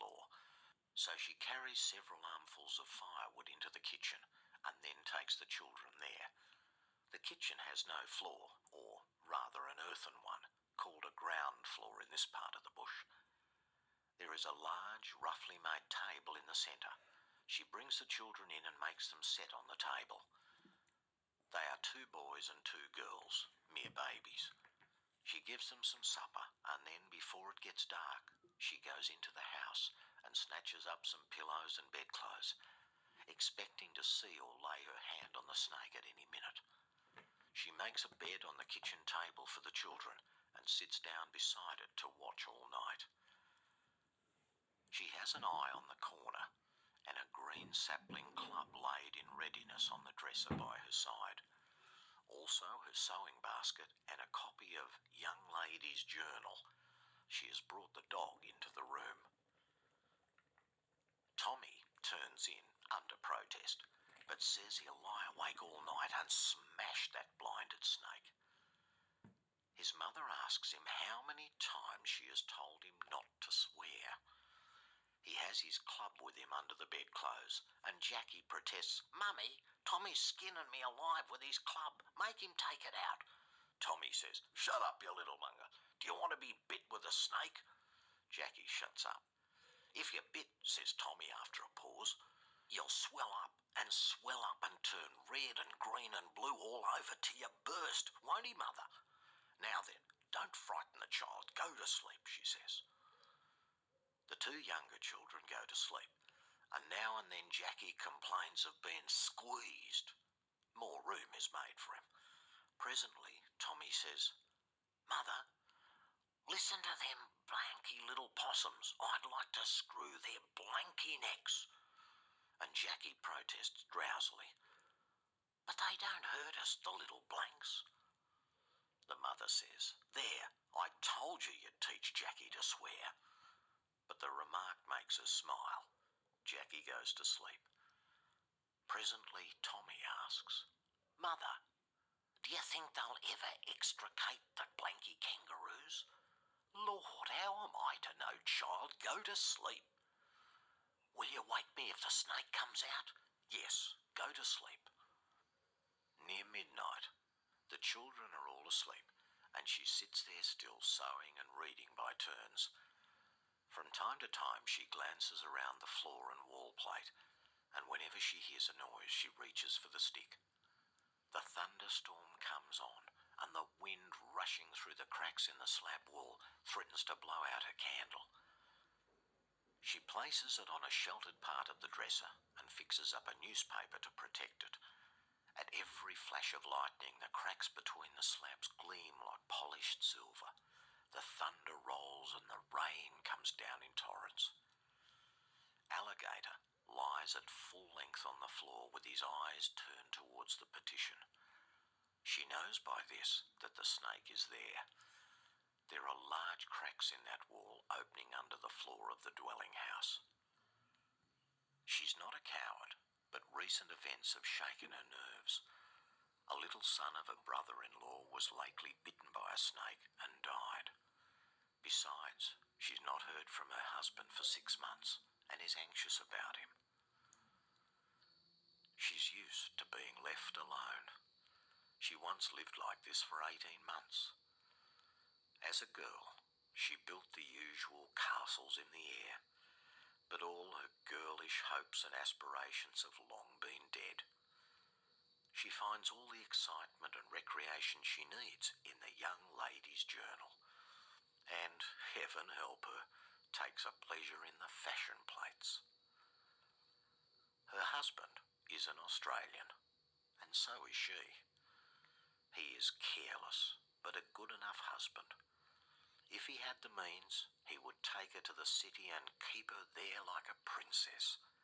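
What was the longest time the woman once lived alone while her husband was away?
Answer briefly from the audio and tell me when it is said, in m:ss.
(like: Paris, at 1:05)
18 months, at 3:53.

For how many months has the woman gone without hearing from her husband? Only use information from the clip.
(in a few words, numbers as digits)
6.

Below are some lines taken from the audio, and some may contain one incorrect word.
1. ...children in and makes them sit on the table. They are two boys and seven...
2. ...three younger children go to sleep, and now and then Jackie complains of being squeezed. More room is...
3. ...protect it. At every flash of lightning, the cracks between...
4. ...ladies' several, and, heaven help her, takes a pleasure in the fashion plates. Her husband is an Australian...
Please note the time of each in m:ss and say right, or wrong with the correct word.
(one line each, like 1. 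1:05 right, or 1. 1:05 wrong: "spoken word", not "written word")
1. 0:18 wrong: "two", not "seven"
2. 1:44 wrong: "two", not "three"
3. 3:04 right
4. 4:09 wrong: "journal", not "several".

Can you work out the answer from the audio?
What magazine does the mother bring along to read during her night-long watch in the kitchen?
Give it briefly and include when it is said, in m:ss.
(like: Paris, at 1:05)
Young Lady's Journal, at 0:55.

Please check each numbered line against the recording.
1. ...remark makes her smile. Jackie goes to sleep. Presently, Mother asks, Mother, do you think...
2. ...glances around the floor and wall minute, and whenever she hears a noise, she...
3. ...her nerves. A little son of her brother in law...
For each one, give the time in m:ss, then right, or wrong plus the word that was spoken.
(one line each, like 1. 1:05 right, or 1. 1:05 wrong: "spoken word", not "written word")
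1. 2:14 wrong: "Tommy", not "Mother"
2. 2:44 wrong: "plate", not "minute"
3. 3:34 right.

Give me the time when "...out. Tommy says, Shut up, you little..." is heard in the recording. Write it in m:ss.
1:22.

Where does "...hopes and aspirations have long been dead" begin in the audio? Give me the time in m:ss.
4:01.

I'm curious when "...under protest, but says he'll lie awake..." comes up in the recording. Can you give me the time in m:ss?
1:02.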